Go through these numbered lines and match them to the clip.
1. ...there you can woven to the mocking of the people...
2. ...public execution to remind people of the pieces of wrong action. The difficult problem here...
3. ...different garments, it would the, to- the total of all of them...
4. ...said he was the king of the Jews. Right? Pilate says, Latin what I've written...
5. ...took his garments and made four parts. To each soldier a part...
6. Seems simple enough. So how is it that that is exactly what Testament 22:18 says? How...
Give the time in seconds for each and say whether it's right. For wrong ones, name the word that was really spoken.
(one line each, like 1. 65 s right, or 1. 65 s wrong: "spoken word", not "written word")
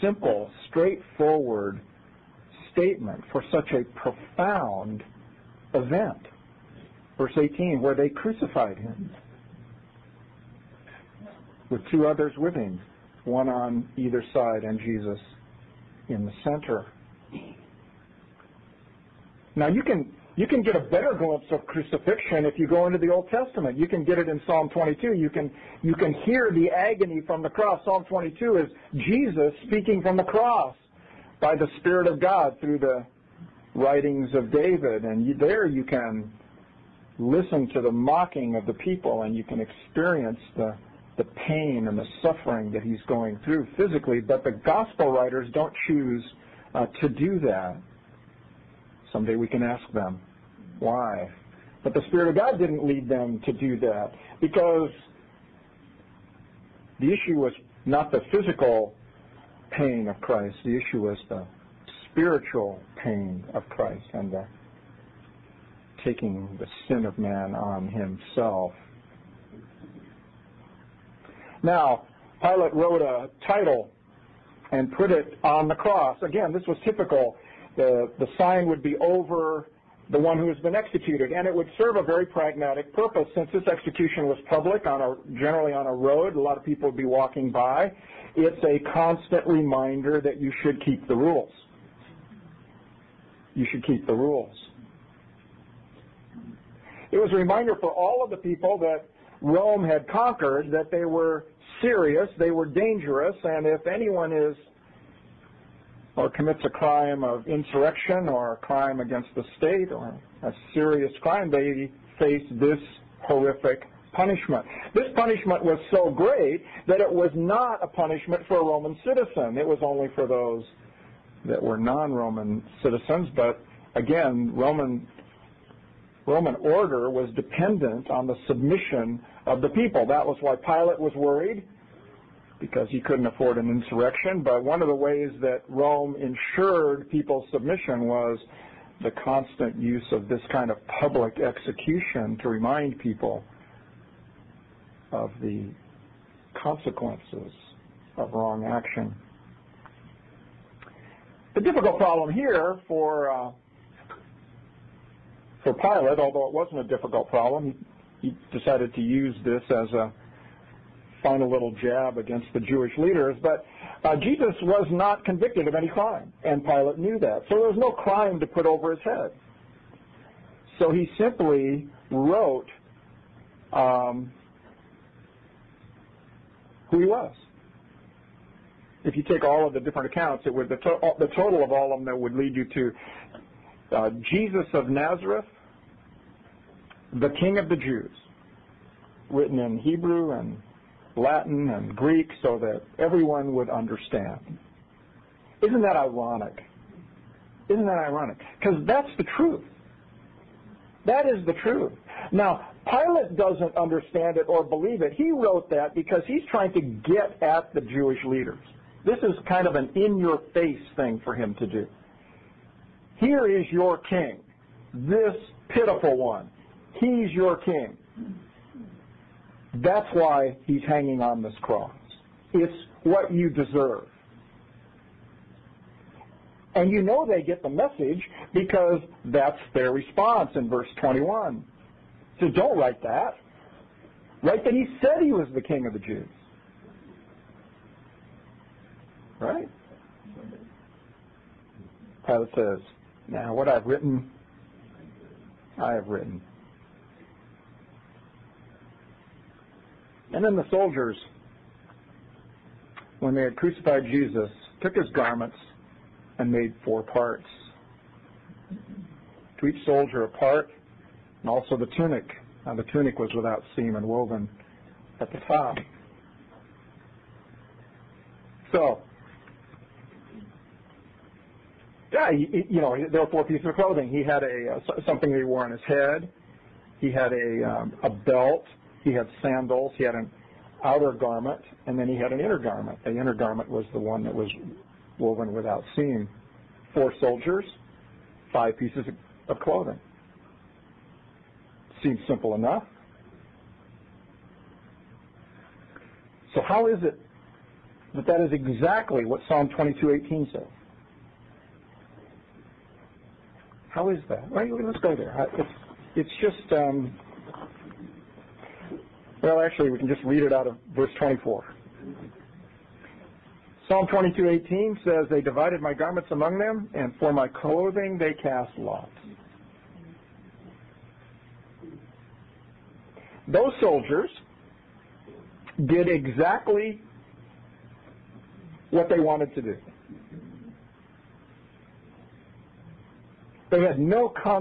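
1. 35 s wrong: "listen", not "woven"
2. 141 s wrong: "consequences", not "pieces"
3. 179 s wrong: "accounts", not "garments"
4. 235 s wrong: "Now", not "Latin"
5. 254 s right
6. 292 s wrong: "Psalm", not "Testament".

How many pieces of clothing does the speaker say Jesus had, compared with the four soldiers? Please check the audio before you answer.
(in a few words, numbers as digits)
5.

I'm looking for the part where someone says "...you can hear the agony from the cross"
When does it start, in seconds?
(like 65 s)
25 s.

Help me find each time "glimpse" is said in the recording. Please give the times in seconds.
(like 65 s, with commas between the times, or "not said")
21 s.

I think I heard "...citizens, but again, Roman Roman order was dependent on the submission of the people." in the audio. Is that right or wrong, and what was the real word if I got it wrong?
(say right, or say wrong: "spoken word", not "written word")
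right.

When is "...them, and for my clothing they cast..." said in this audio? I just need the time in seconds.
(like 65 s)
316 s.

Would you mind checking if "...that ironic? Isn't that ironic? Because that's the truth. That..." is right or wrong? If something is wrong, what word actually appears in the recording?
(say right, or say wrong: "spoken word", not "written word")
right.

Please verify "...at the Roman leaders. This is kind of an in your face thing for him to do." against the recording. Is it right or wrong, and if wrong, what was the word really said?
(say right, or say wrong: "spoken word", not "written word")
wrong: "Jewish", not "Roman".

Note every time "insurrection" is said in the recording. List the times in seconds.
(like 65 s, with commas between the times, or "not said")
107 s, 133 s.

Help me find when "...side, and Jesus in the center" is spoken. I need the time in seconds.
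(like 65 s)
14 s.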